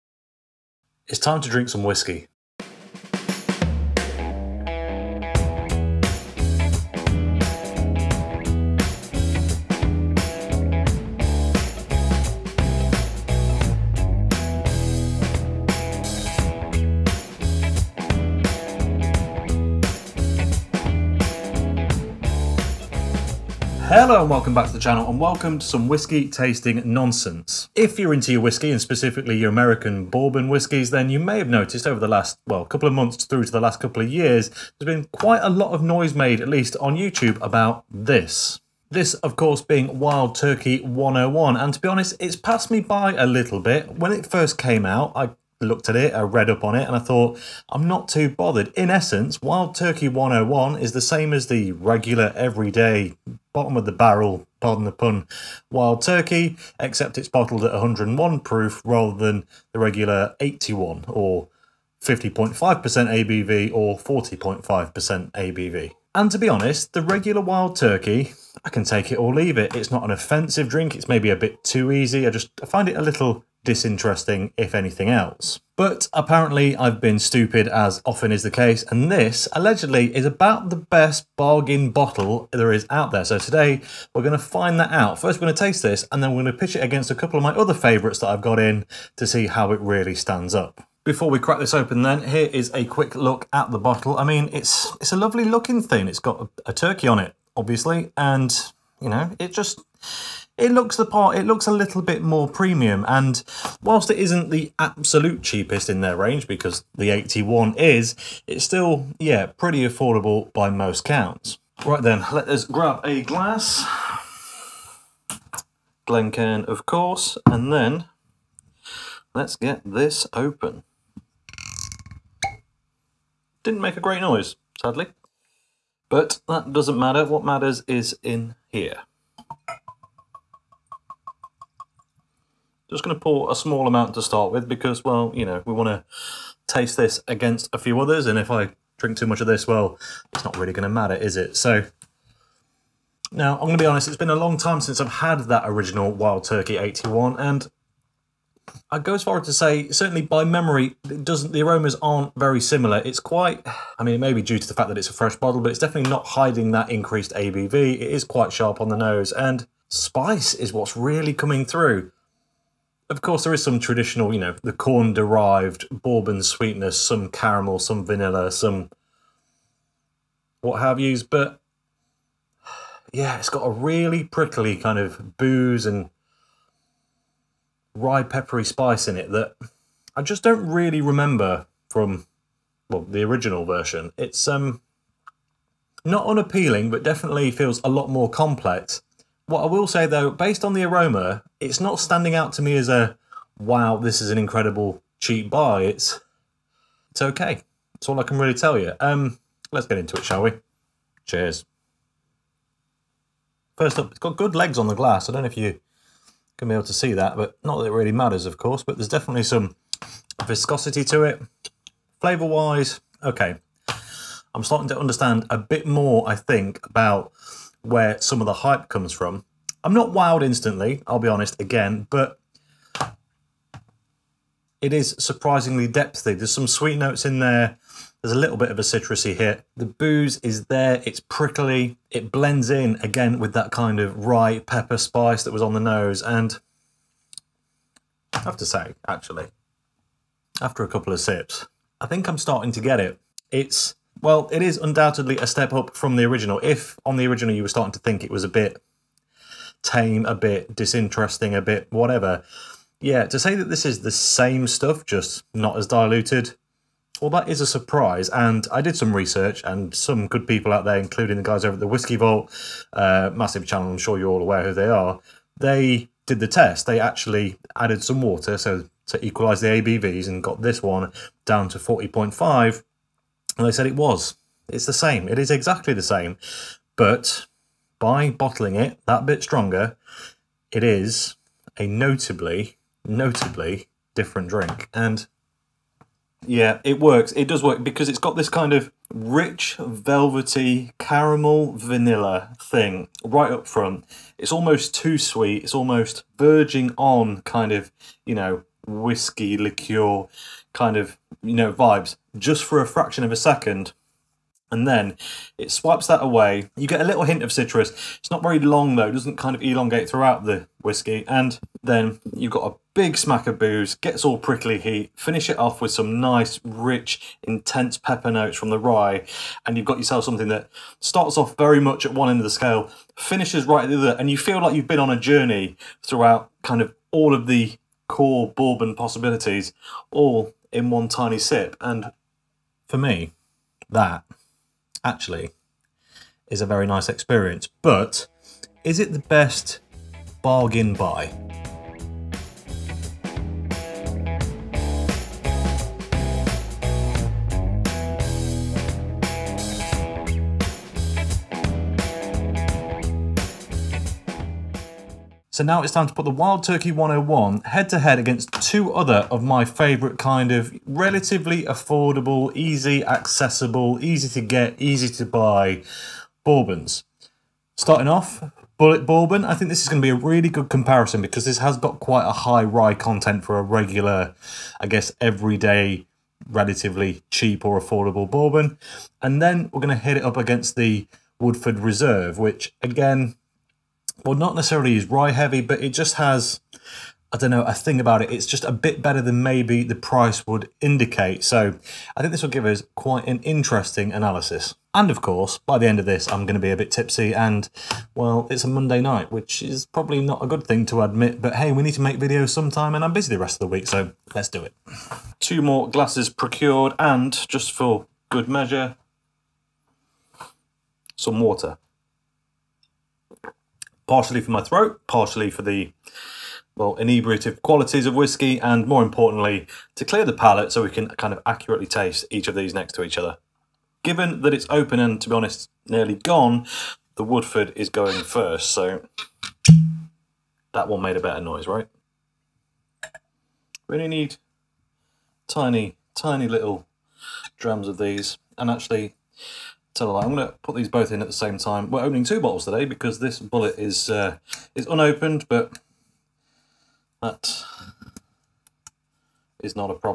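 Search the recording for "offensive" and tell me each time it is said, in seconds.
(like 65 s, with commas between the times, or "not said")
70 s.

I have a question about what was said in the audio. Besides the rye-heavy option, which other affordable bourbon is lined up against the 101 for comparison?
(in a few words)
Woodford Reserve.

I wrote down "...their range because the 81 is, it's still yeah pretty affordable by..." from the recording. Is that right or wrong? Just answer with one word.
right.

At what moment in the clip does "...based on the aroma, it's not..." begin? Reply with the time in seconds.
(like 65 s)
190 s.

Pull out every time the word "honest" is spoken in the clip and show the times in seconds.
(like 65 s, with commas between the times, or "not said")
41 s, 66 s, 143 s, 221 s, 425 s.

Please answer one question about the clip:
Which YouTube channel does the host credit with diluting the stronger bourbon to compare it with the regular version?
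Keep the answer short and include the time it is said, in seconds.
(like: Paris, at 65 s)
The Whiskey Vault, at 261 s.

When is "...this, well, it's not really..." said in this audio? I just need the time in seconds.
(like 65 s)
139 s.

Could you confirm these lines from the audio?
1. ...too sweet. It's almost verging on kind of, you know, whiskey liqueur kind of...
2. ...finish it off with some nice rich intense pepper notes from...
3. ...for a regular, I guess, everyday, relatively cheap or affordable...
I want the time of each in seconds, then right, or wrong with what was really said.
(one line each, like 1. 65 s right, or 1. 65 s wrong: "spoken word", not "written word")
1. 294 s right
2. 315 s right
3. 373 s right.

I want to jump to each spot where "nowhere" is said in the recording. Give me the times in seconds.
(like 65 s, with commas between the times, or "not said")
not said.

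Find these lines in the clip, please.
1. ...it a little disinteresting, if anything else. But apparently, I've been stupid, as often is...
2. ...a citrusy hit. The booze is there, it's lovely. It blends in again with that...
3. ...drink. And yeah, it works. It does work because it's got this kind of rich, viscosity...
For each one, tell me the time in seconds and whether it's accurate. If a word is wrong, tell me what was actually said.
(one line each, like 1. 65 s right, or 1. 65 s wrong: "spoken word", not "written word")
1. 72 s right
2. 228 s wrong: "prickly", not "lovely"
3. 284 s wrong: "velvety", not "viscosity".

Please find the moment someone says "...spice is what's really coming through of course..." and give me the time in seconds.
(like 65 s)
159 s.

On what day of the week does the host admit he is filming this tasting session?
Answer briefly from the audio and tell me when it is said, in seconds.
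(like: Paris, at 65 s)
Monday, at 398 s.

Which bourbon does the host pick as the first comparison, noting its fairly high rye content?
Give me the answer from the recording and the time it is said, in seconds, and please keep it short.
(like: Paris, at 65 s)
Bulleit Bourbon, at 368 s.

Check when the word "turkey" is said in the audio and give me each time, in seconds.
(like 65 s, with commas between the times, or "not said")
40 s, 49 s, 56 s, 67 s, 96 s, 146 s, 356 s.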